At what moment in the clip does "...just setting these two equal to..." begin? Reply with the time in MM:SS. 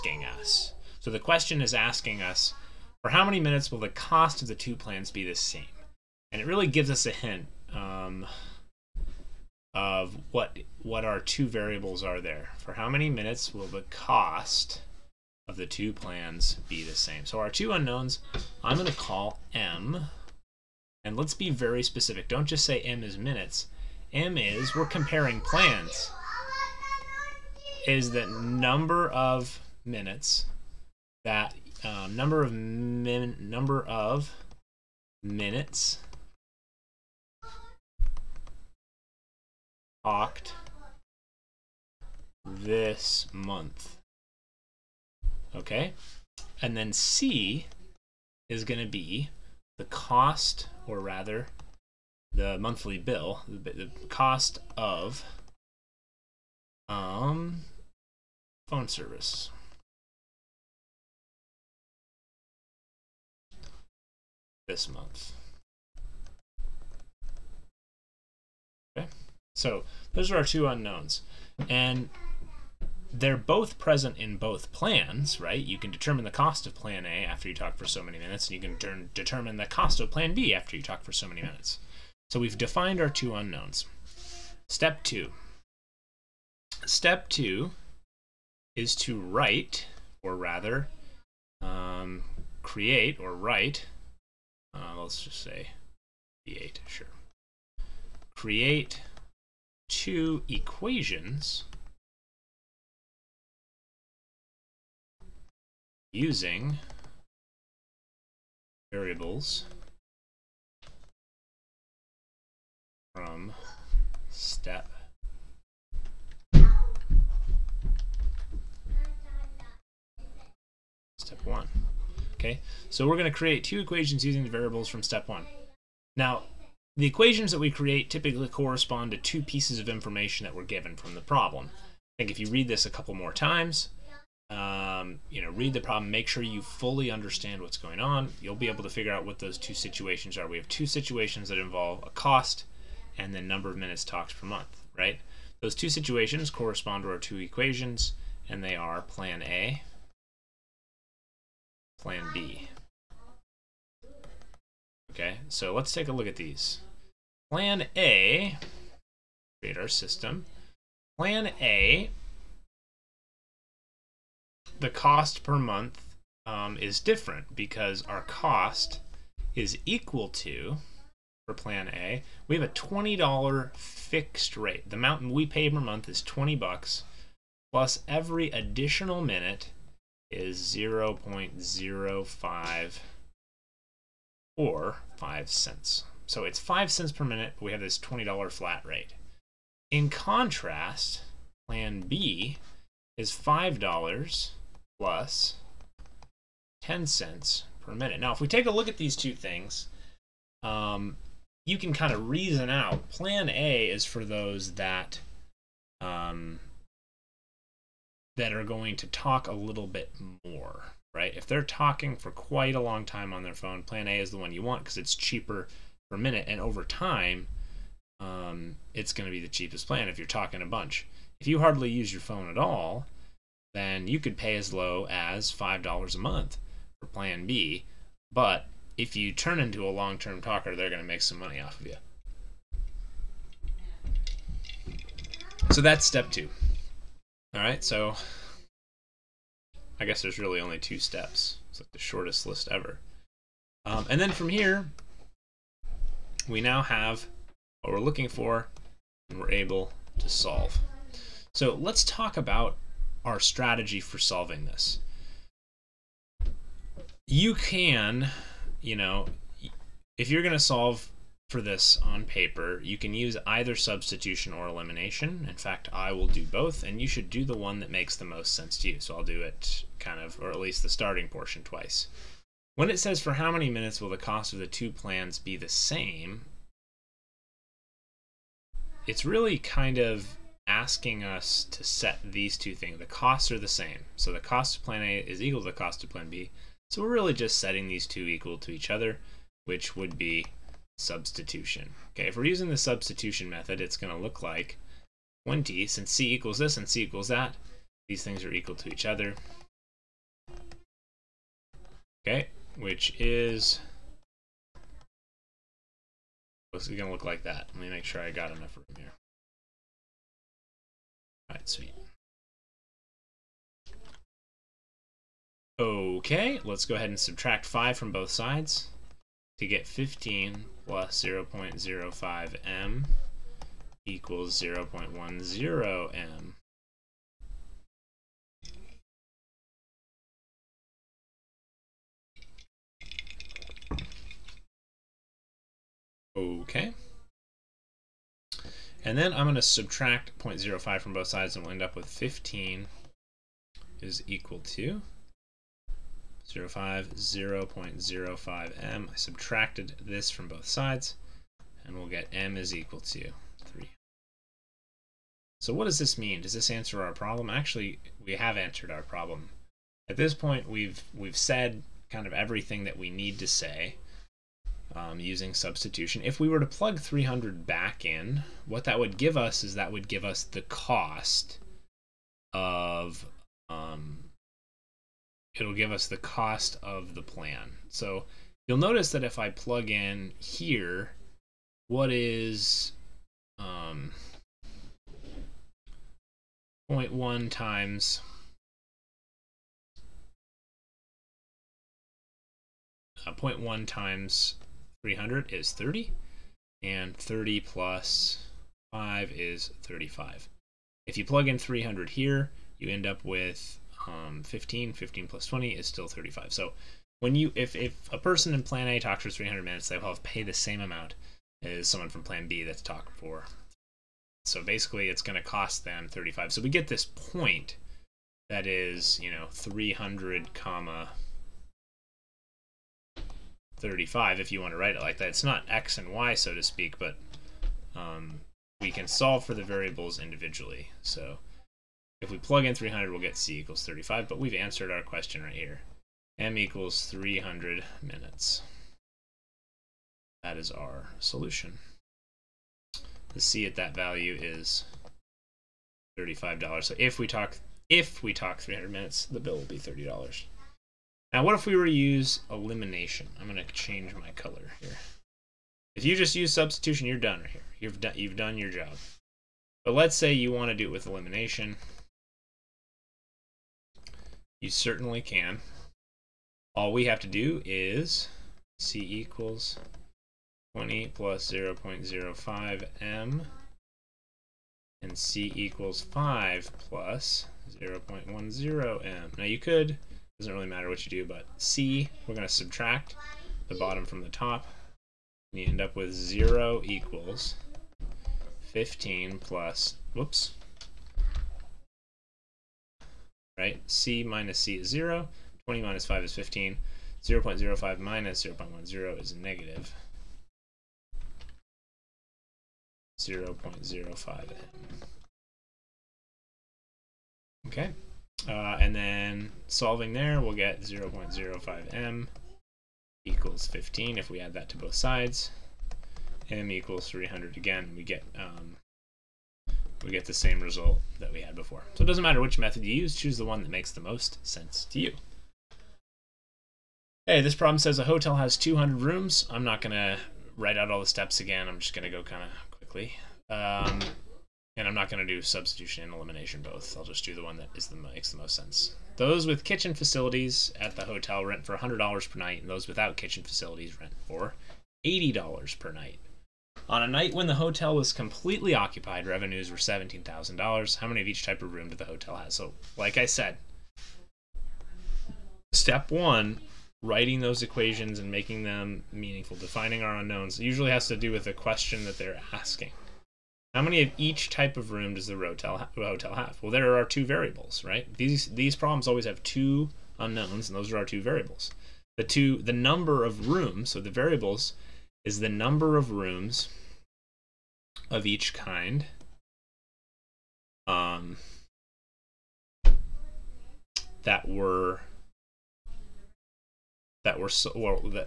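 04:47.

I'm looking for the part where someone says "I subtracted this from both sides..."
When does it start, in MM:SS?
05:49.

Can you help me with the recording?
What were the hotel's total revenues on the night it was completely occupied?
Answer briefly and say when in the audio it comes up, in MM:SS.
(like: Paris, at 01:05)
$17,000, at 09:09.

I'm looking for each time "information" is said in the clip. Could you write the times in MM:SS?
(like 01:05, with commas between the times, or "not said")
02:09.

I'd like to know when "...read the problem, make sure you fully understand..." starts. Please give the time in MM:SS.
02:15.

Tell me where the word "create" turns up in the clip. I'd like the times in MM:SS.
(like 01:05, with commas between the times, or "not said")
01:32, 01:38, 02:03, 02:07, 02:39.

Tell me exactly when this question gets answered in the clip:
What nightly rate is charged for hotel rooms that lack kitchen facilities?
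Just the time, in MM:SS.
09:05.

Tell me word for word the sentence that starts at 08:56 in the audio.
I'll just do the one that is the makes the most sense.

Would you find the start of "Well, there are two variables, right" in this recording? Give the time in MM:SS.
09:26.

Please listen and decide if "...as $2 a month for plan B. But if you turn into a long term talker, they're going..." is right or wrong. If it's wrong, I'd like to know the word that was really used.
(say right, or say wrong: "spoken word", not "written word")
wrong: "5", not "2".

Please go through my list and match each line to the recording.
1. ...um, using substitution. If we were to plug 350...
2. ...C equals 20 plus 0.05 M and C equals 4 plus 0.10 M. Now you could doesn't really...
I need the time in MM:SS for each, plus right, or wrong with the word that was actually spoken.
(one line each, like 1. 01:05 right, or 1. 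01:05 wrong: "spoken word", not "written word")
1. 06:04 wrong: "300", not "350"
2. 07:48 wrong: "5", not "4".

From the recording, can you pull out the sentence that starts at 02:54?
The amount we pay per month is 20 bucks plus every additional minute is 0.05 or 5 cents.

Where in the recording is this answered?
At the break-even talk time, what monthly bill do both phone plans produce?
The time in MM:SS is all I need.
06:55.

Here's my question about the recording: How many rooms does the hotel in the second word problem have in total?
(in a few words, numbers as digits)
200.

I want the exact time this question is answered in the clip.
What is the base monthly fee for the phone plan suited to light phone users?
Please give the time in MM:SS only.
03:11.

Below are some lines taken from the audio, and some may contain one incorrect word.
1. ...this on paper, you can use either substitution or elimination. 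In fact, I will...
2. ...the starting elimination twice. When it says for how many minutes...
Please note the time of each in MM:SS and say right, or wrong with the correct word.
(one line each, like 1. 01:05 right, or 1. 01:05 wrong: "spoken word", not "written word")
1. 04:21 right
2. 04:30 wrong: "portion", not "elimination".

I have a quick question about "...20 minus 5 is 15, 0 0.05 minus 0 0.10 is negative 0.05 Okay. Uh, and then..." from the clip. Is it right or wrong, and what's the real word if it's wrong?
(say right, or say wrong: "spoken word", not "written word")
right.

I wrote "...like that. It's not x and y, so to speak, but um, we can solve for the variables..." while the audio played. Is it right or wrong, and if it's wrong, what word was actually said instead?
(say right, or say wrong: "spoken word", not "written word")
right.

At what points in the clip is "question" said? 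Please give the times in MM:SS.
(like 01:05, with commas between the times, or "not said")
00:01, 07:15, 09:21.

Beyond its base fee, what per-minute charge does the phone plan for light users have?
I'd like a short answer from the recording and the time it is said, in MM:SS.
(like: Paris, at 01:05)
10 cents, at 03:16.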